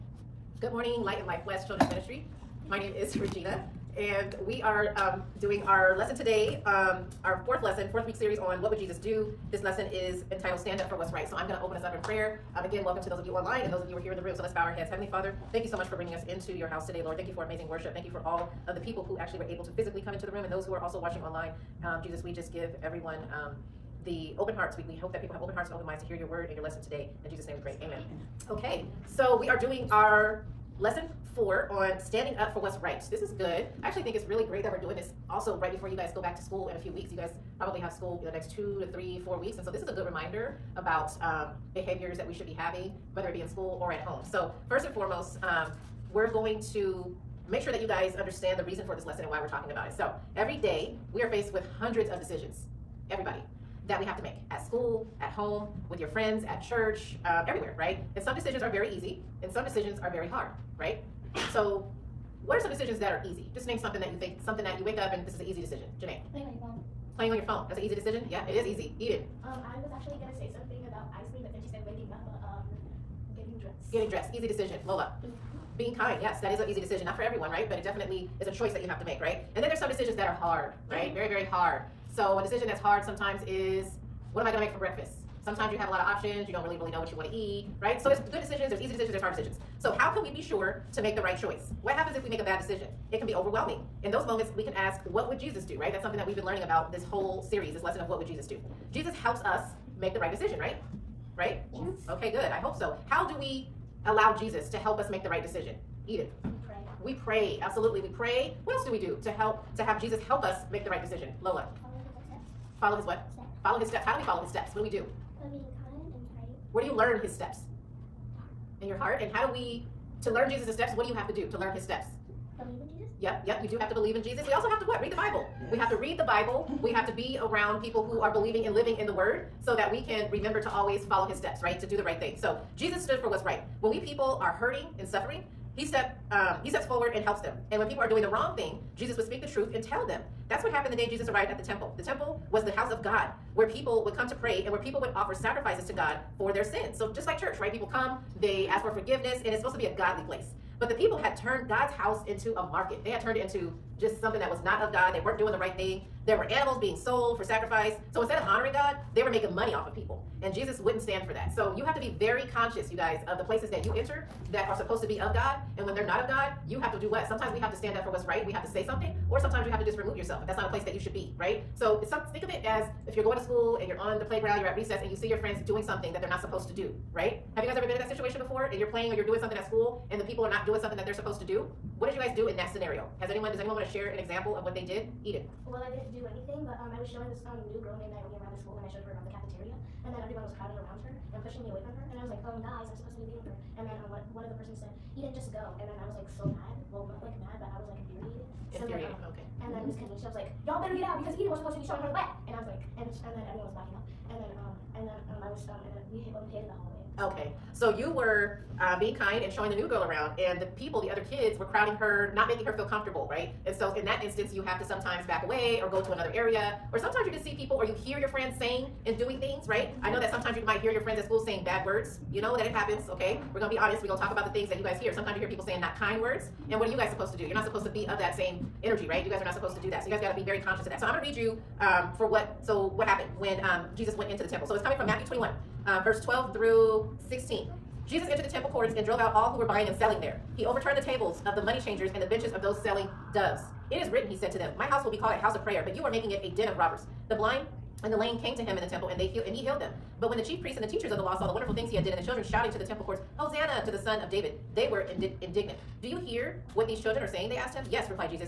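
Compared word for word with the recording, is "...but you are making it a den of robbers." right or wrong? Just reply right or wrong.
right.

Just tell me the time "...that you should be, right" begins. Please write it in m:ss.
2:50.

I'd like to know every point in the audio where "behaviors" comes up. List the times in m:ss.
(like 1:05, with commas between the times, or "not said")
0:41.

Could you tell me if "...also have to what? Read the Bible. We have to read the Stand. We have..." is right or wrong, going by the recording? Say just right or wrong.
wrong.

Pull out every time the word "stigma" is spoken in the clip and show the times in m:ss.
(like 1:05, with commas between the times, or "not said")
not said.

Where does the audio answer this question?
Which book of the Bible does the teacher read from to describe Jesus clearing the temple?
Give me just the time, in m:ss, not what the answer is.
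3:55.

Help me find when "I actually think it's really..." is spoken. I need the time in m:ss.
0:33.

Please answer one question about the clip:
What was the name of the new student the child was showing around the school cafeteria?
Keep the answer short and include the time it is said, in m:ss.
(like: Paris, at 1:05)
Naomi, at 3:08.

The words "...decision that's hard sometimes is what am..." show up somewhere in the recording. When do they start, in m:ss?
1:22.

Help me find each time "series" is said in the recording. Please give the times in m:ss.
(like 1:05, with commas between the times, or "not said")
0:08, 1:37.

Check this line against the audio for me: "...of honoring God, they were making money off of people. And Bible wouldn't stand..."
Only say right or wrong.
wrong.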